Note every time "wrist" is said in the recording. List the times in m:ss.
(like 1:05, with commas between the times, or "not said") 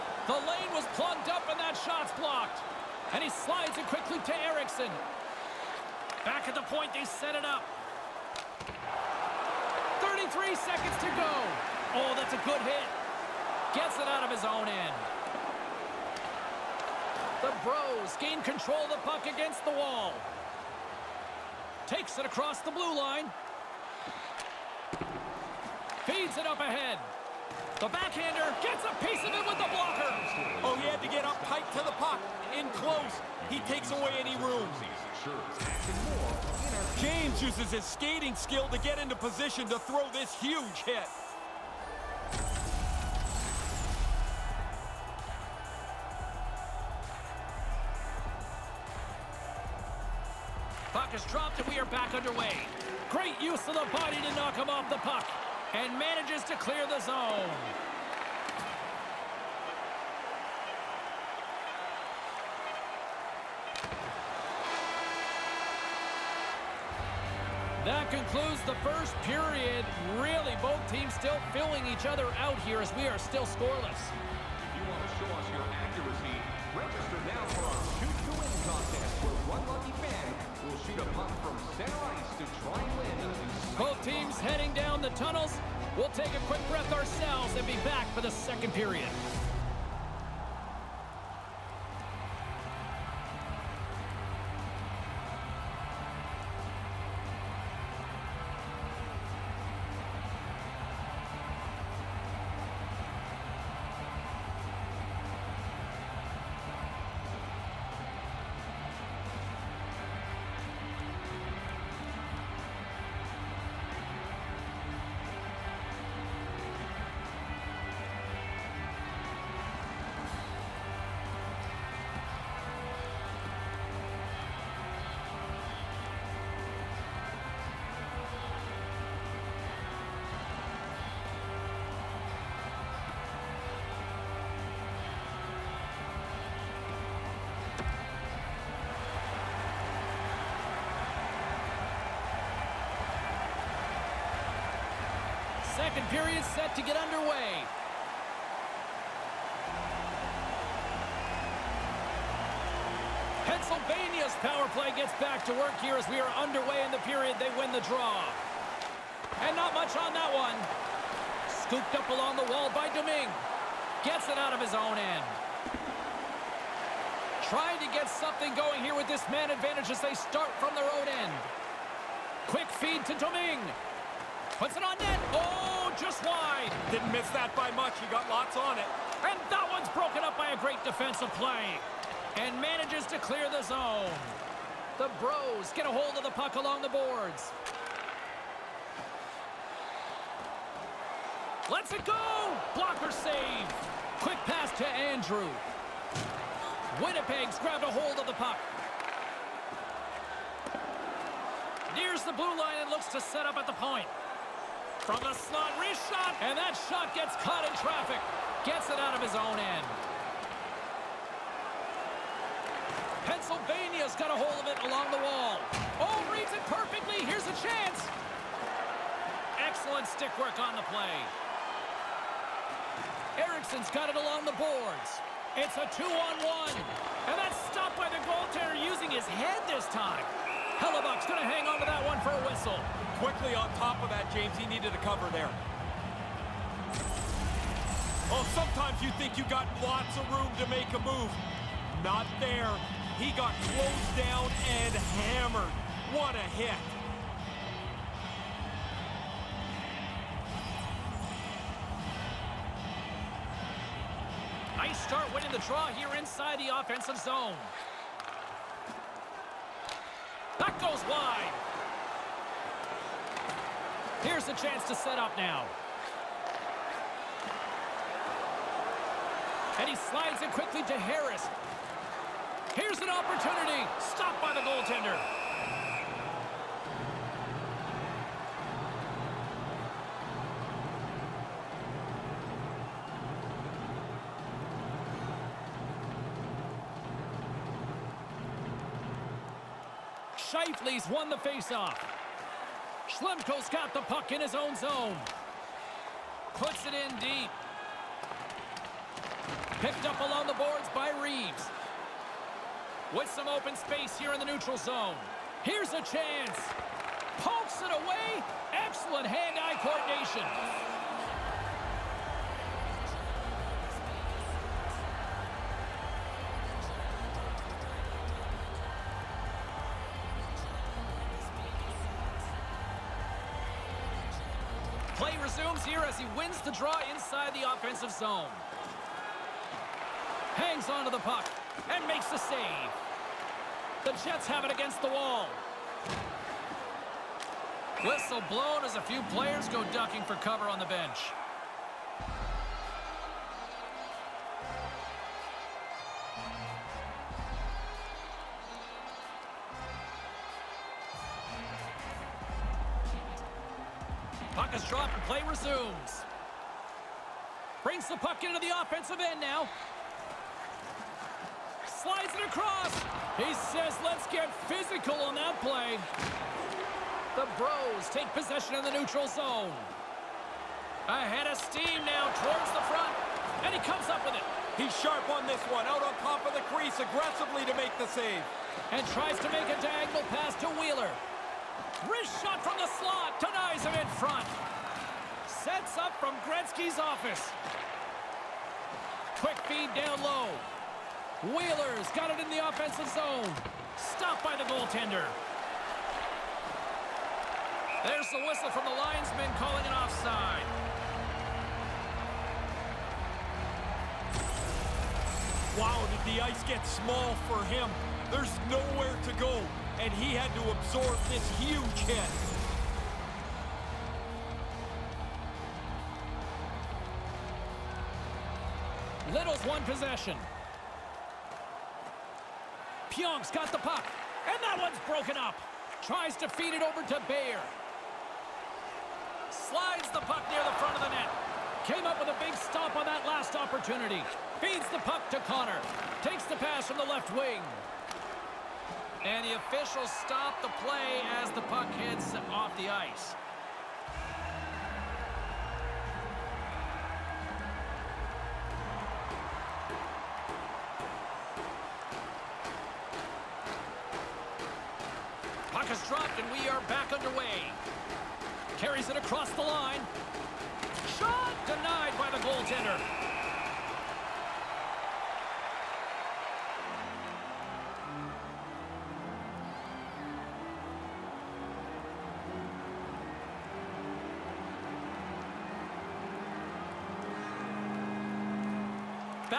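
3:25, 6:22.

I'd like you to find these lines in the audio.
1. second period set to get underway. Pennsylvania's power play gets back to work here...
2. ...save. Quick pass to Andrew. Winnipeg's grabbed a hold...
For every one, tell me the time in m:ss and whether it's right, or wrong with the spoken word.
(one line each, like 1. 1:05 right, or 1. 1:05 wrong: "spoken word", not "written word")
1. 2:25 right
2. 3:13 right.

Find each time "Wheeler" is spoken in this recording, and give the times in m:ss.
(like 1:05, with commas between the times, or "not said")
6:20, 6:31.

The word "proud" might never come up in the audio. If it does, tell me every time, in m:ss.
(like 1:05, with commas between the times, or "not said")
not said.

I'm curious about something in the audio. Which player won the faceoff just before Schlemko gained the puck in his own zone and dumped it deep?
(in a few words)
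Scheifele.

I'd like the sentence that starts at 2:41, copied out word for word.
Scooped up along the wall by Domingue.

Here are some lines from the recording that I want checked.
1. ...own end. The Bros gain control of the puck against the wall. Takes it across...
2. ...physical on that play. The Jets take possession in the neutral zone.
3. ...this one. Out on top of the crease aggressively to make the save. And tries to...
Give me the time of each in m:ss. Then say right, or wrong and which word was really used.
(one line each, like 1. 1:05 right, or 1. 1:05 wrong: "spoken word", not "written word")
1. 0:14 right
2. 6:04 wrong: "Bros", not "Jets"
3. 6:15 right.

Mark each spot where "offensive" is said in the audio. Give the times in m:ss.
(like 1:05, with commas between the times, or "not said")
4:16, 5:27, 5:58, 6:32.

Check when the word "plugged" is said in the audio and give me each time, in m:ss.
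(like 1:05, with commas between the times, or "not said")
0:00.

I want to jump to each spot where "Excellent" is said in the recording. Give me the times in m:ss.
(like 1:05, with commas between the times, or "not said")
3:39, 5:08.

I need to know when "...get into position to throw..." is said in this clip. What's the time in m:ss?
0:38.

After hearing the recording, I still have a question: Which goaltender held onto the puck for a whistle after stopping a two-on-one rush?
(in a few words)
Hellebuyck.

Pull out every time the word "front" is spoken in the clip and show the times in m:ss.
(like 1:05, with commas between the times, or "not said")
6:12, 6:24, 7:10.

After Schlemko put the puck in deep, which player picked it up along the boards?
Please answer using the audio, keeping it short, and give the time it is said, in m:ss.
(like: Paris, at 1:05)
Reeves, at 5:01.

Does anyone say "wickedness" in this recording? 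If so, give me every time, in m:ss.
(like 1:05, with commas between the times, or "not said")
not said.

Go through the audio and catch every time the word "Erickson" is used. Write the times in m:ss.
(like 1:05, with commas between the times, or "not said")
0:04, 3:43.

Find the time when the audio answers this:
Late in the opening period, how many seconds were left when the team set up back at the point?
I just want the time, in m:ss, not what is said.
0:10.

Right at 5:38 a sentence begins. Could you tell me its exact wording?
Whistle blown as a few players go ducking for cover on the bench.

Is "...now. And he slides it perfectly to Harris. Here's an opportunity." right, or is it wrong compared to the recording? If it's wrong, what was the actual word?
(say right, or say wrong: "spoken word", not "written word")
wrong: "quickly", not "perfectly".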